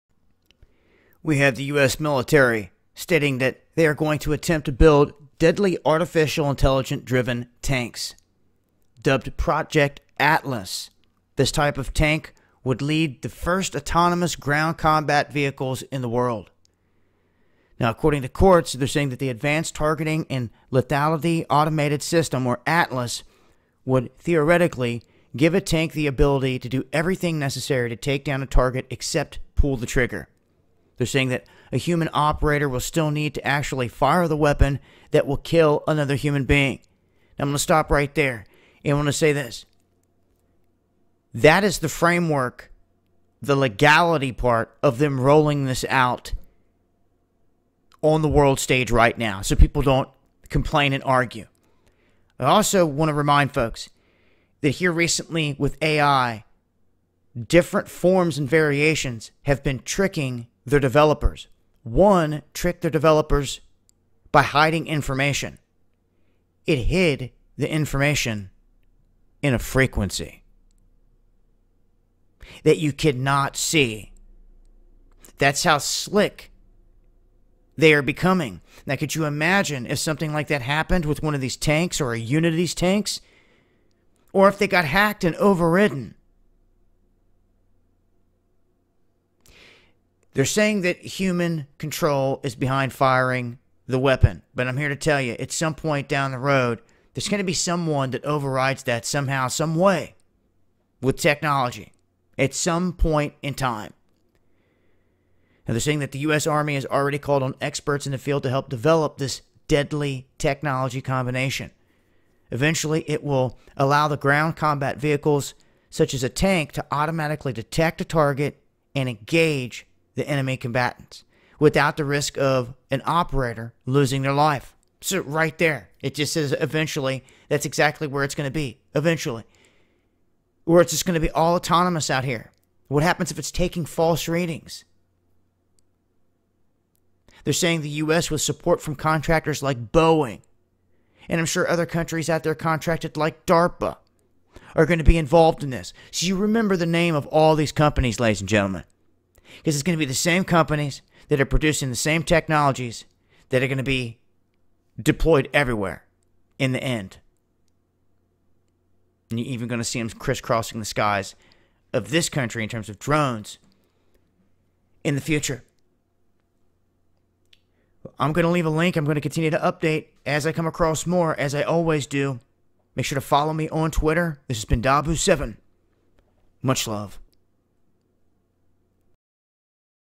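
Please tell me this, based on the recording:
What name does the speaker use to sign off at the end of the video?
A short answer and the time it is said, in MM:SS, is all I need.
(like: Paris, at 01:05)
Dabu7, at 02:54.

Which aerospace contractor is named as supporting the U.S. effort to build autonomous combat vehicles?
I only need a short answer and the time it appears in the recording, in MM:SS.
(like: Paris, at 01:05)
Boeing, at 02:19.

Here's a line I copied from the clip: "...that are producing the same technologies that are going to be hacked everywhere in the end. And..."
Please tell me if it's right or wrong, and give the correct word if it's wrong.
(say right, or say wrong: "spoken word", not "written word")
wrong: "deployed", not "hacked".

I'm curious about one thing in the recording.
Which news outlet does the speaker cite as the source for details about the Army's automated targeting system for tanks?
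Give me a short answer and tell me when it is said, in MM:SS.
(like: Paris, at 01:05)
Quartz, at 00:18.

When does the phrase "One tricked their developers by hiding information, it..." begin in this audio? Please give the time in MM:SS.
01:01.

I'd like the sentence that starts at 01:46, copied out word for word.
Army has already called on experts in the field to help develop this deadly technology combination.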